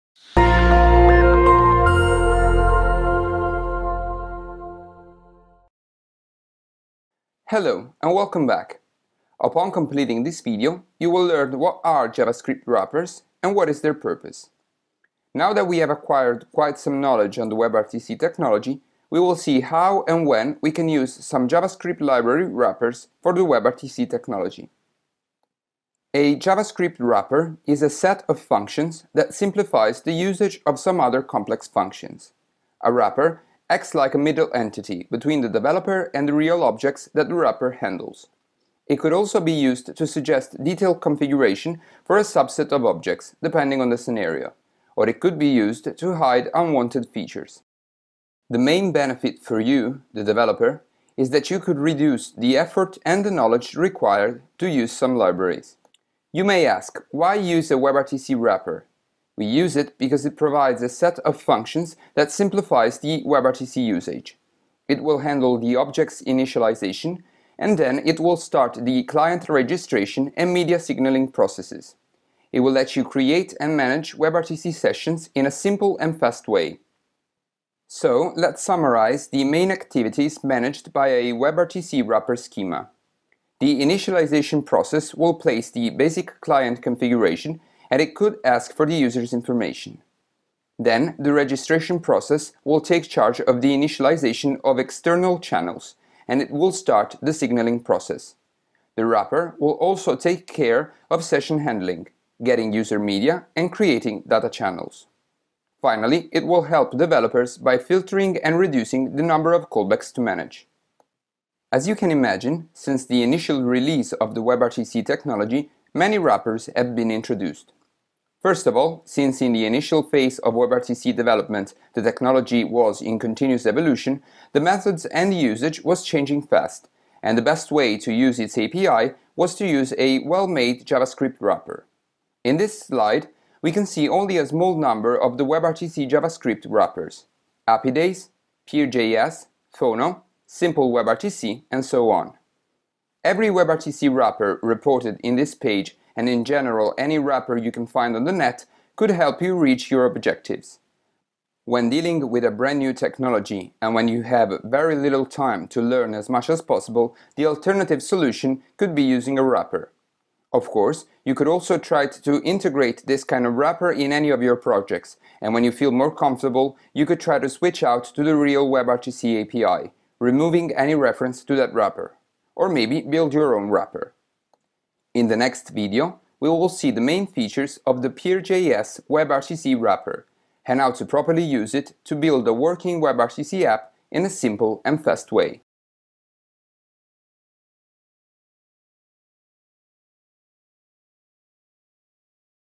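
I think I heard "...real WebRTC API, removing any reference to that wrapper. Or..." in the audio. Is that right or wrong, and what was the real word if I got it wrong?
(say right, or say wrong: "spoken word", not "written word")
right.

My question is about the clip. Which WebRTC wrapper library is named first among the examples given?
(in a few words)
Apidaze.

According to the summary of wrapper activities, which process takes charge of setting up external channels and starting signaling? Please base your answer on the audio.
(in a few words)
The registration process.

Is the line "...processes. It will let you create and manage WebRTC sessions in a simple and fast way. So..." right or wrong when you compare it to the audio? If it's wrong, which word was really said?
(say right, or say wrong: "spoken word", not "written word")
right.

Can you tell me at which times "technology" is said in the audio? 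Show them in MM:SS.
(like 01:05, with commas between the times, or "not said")
00:18, 00:24, 01:55, 02:02, 02:32.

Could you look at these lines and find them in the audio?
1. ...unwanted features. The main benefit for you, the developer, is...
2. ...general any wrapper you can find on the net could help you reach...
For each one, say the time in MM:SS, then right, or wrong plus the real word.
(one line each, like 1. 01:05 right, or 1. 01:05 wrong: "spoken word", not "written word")
1. 00:46 right
2. 02:26 right.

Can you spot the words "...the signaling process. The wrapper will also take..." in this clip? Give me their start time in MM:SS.
01:37.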